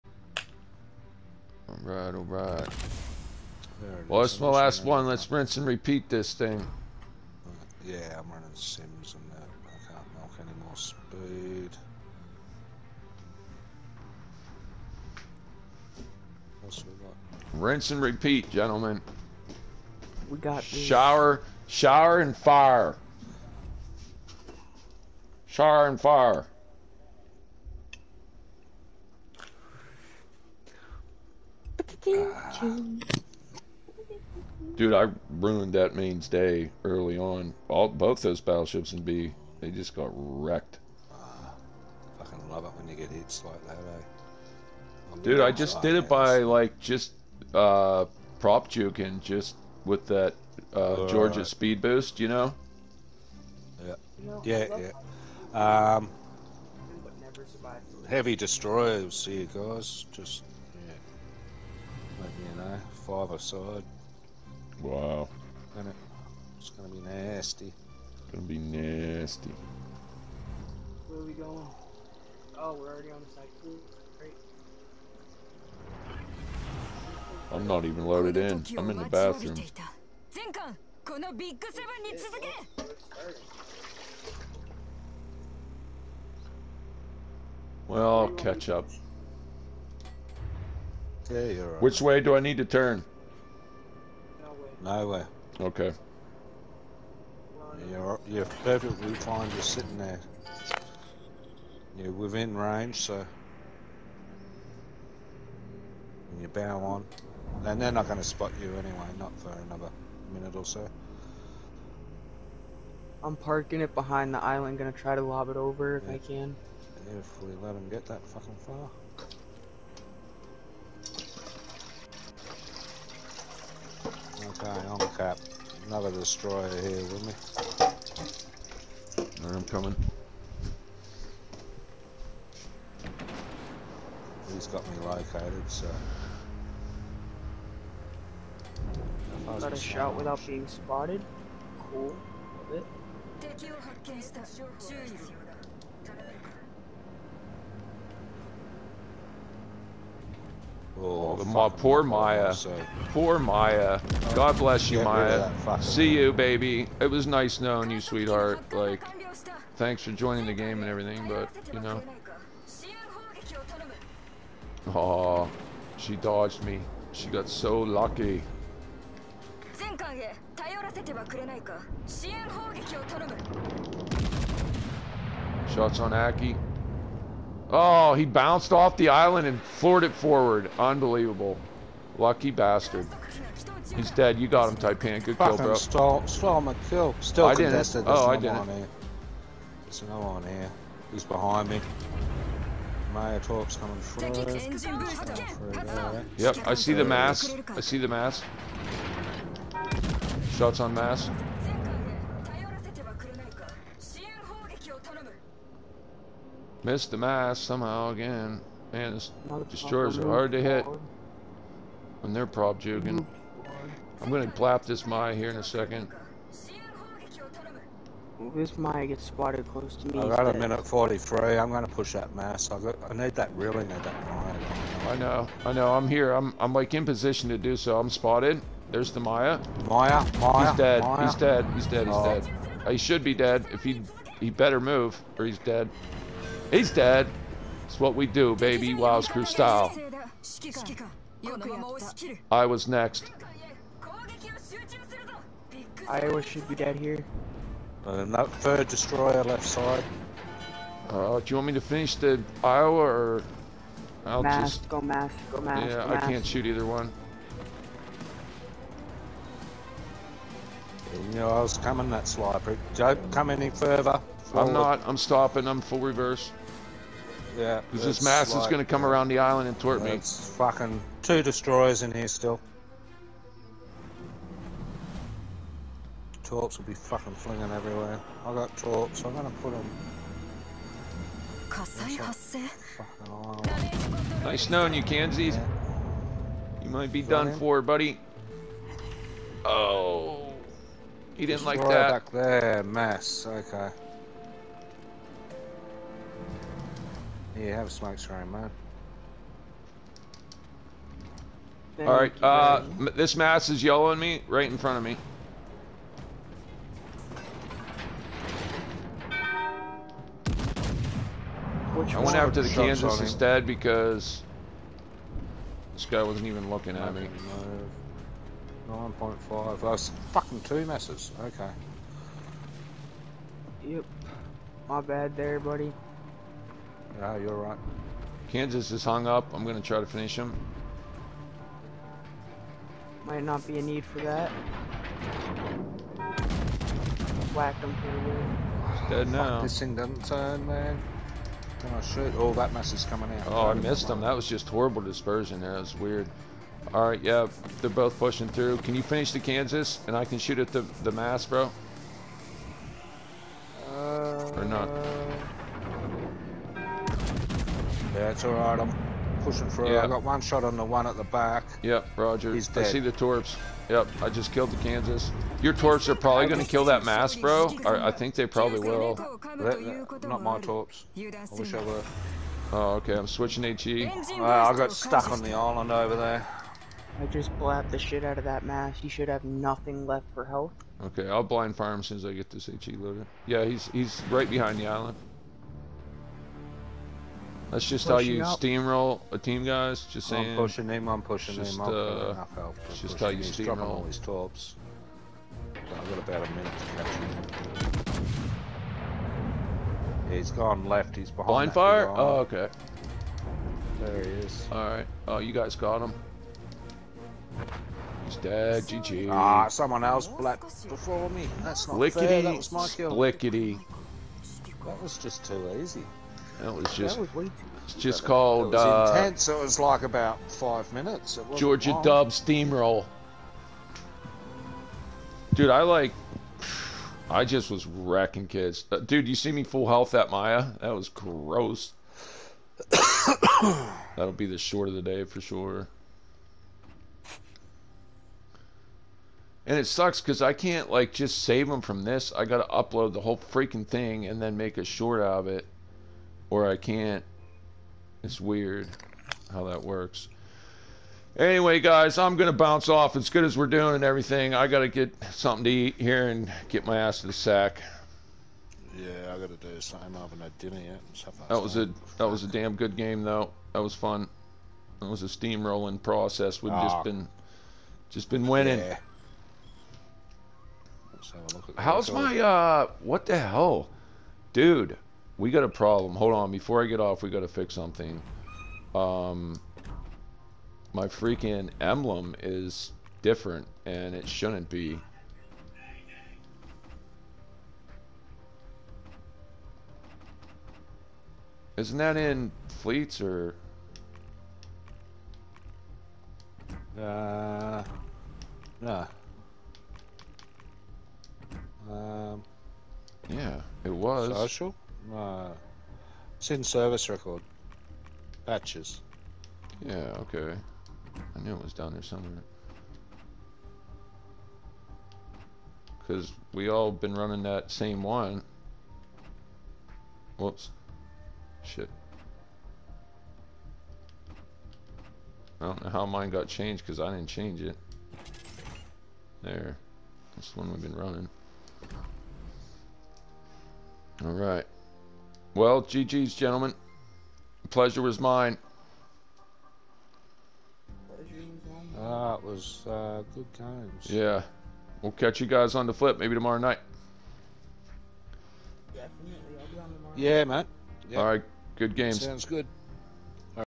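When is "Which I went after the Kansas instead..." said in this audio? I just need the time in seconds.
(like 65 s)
311 s.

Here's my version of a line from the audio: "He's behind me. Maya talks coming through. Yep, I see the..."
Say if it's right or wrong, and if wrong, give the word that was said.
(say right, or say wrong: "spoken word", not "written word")
right.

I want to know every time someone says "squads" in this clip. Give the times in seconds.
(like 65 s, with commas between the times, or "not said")
not said.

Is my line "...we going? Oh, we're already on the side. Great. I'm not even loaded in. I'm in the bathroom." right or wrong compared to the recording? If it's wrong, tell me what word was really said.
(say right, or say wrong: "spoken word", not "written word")
right.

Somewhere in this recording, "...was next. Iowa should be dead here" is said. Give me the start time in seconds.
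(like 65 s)
242 s.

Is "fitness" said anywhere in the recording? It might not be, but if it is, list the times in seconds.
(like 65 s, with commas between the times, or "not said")
not said.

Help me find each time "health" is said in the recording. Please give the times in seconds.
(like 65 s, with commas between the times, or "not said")
380 s, 429 s.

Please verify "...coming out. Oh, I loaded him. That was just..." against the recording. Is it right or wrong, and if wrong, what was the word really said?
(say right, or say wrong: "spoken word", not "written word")
wrong: "missed", not "loaded".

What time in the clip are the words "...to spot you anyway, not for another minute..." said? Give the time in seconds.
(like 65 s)
108 s.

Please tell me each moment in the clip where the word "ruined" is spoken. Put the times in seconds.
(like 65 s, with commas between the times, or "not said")
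35 s.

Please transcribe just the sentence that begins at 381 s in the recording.
Okay, I'll blind fire him as soon as I get this HE loaded.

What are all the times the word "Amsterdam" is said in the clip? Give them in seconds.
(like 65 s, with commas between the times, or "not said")
not said.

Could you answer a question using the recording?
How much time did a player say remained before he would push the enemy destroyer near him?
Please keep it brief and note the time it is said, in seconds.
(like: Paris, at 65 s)
1 minute 43, at 220 s.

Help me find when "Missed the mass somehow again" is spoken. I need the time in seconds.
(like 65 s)
206 s.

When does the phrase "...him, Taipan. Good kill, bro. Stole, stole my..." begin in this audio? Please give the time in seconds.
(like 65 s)
184 s.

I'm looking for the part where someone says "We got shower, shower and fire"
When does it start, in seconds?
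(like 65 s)
20 s.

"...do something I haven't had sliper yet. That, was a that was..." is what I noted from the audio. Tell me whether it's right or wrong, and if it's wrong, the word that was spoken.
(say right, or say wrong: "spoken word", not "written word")
wrong: "dinner", not "sliper".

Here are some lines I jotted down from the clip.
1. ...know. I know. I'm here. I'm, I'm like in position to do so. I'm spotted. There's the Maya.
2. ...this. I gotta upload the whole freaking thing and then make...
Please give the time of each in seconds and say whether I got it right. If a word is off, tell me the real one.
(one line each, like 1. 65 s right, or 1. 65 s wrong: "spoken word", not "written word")
1. 225 s right
2. 442 s right.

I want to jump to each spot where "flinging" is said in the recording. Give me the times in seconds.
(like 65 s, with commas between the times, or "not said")
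277 s.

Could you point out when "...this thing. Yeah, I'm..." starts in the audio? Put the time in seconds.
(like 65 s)
6 s.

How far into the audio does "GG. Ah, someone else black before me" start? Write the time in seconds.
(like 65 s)
408 s.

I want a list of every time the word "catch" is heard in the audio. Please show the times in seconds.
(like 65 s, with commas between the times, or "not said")
88 s, 397 s, 545 s.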